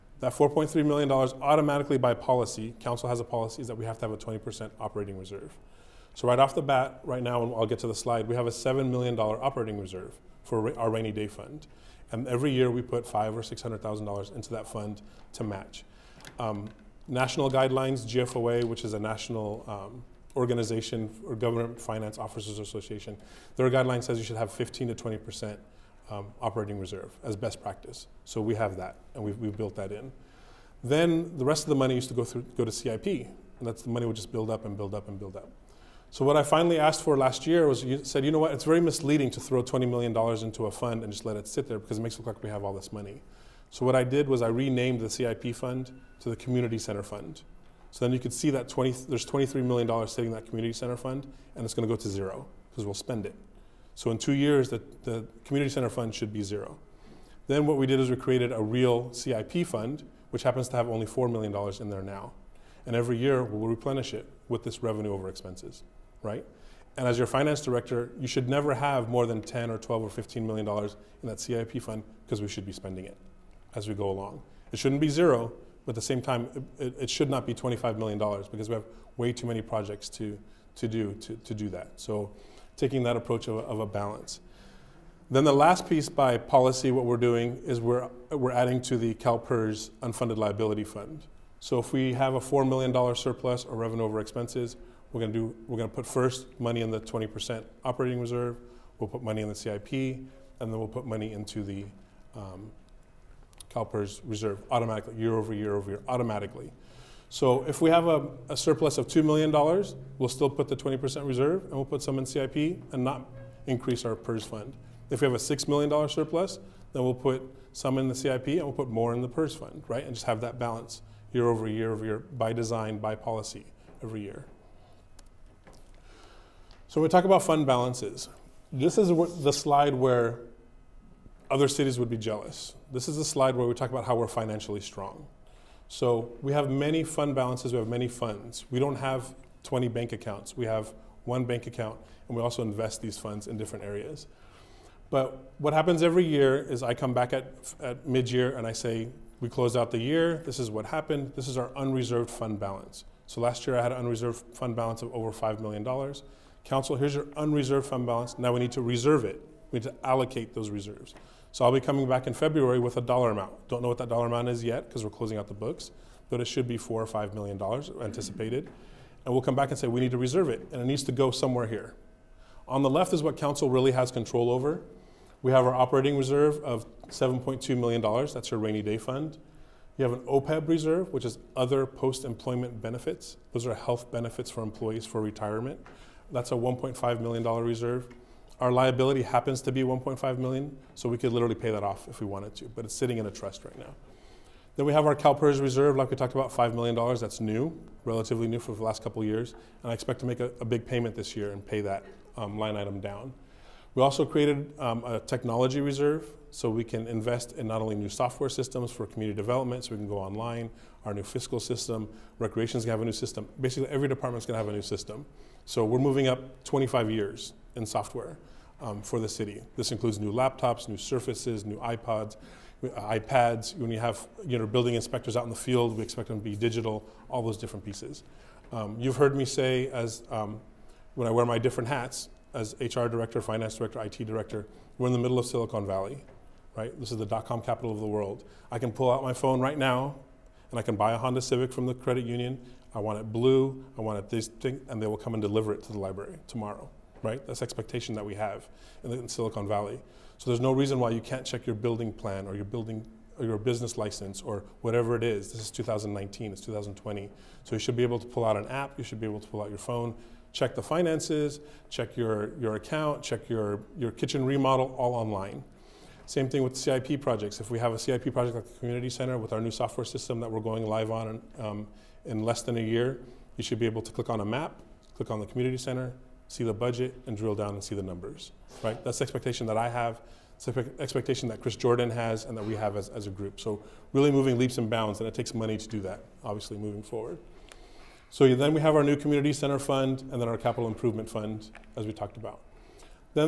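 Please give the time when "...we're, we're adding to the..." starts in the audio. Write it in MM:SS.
01:27.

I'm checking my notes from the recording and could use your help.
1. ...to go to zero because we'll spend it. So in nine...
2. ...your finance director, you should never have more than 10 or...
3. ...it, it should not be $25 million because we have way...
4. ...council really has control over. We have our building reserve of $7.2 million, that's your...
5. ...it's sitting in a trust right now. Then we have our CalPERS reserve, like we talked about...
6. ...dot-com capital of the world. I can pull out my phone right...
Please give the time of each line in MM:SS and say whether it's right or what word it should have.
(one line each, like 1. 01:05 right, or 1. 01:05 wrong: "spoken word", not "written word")
1. 00:51 wrong: "two", not "nine"
2. 01:07 right
3. 01:16 right
4. 02:53 wrong: "operating", not "building"
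5. 03:12 right
6. 03:57 right.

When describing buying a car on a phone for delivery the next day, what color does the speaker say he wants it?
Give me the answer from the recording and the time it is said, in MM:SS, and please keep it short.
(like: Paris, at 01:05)
Blue, at 04:03.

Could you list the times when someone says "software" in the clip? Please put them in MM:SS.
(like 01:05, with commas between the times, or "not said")
03:28, 03:37, 04:29.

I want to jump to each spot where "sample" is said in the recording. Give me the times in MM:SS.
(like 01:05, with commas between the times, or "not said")
not said.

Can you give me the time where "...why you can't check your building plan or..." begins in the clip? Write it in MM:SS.
04:10.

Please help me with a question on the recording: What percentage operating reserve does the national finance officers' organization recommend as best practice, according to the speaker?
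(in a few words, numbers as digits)
15 to 20 percent.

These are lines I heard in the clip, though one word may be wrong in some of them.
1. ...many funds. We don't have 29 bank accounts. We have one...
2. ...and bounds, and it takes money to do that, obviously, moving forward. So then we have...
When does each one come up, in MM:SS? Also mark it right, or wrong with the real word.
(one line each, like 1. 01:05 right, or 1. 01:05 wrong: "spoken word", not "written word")
1. 02:17 wrong: "20", not "29"
2. 04:44 right.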